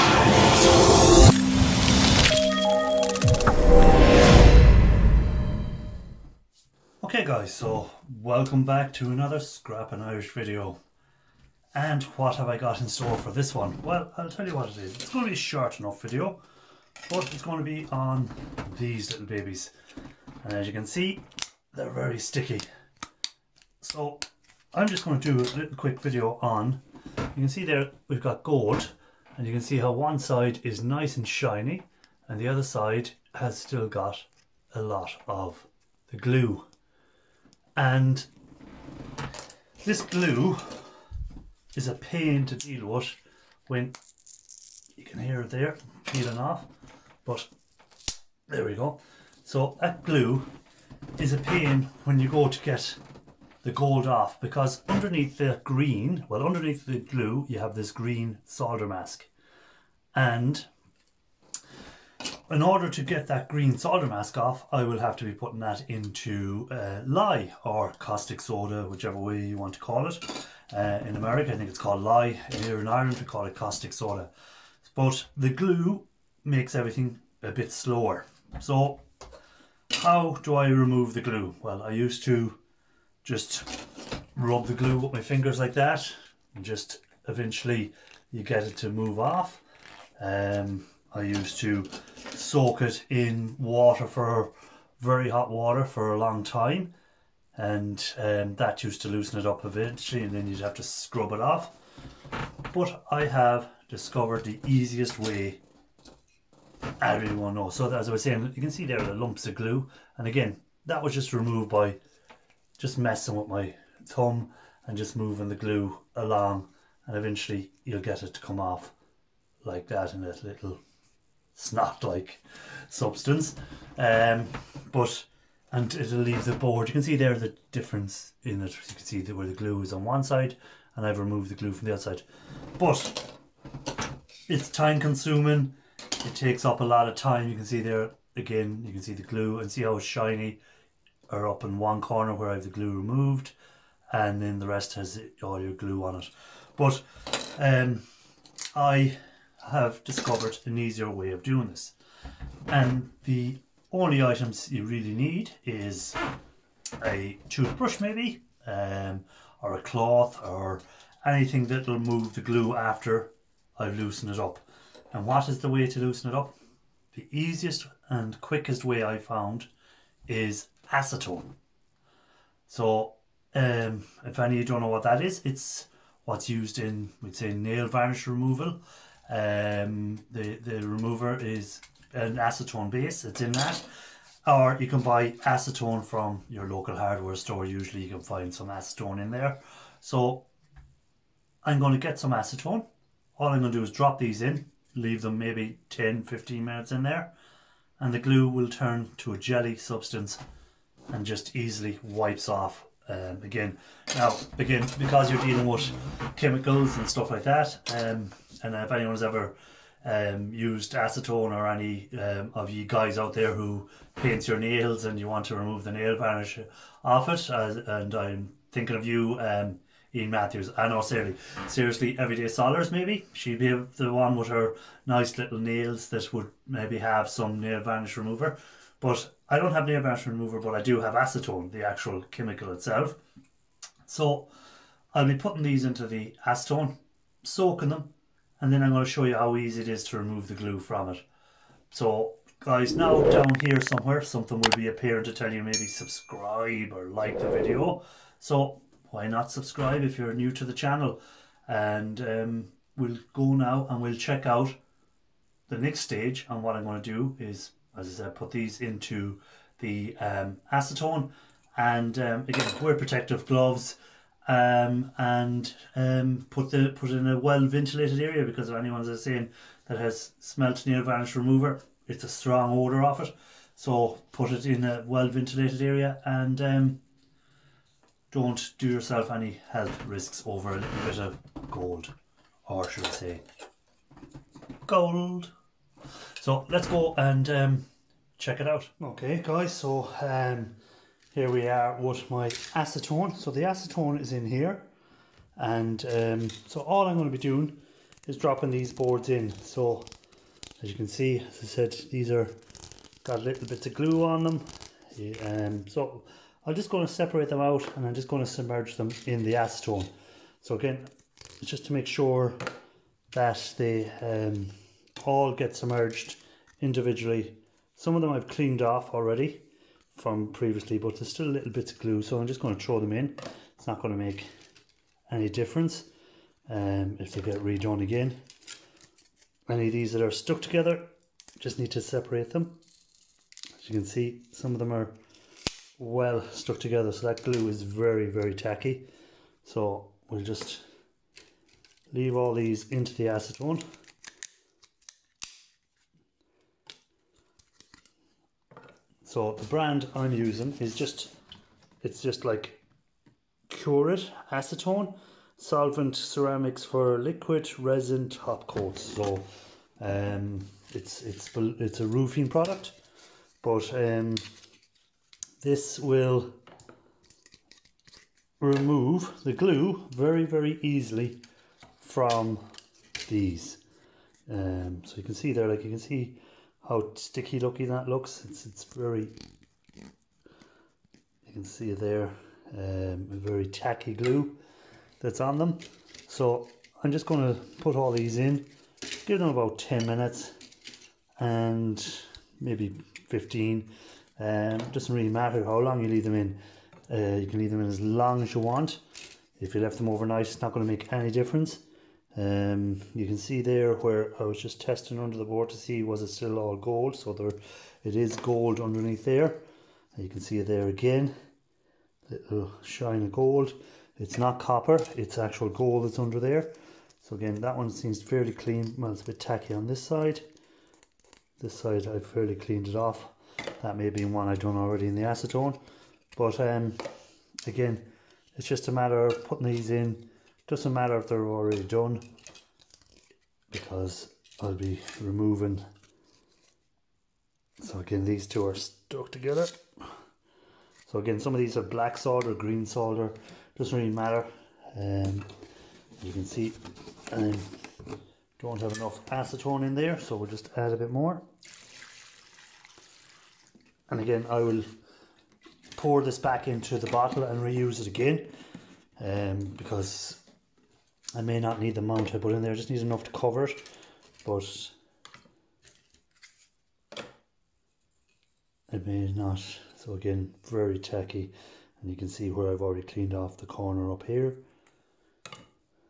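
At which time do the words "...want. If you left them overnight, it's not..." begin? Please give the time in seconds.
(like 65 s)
398 s.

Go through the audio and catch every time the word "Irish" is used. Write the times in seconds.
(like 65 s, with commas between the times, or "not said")
9 s.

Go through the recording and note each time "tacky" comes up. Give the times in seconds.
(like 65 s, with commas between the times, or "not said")
338 s, 383 s, 419 s, 470 s.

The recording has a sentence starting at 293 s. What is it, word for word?
So the acetone is in here.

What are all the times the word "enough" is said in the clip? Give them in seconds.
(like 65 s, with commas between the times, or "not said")
15 s, 448 s, 463 s.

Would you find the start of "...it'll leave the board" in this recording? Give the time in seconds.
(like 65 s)
125 s.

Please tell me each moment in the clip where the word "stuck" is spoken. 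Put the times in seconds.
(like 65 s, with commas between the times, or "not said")
330 s, 336 s, 438 s.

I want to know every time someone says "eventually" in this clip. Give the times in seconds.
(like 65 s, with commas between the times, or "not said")
87 s, 99 s, 117 s.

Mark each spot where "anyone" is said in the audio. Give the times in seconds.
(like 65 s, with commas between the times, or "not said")
208 s, 268 s.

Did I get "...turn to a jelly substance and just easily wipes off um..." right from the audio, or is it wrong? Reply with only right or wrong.
right.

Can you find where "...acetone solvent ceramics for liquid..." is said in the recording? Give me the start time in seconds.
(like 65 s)
354 s.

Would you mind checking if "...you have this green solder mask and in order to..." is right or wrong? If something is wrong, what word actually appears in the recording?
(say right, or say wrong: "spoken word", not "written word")
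right.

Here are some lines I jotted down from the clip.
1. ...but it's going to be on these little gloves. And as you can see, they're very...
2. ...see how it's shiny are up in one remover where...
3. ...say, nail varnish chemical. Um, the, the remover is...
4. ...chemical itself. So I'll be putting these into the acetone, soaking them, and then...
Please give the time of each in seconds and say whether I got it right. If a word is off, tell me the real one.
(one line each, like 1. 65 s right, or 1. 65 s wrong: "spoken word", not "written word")
1. 17 s wrong: "babies", not "gloves"
2. 139 s wrong: "corner", not "remover"
3. 177 s wrong: "removal", not "chemical"
4. 232 s right.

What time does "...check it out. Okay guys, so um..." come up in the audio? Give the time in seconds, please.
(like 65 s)
288 s.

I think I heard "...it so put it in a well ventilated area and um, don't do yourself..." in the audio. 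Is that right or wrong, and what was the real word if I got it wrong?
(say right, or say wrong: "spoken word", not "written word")
right.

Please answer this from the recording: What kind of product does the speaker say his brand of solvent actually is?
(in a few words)
roofing product.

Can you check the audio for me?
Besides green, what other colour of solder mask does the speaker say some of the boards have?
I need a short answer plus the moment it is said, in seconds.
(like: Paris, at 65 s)
black, at 441 s.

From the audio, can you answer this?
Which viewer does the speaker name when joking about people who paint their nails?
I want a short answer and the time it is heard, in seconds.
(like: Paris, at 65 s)
Ian Matthews, at 220 s.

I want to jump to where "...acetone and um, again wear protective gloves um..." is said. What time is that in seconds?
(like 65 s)
260 s.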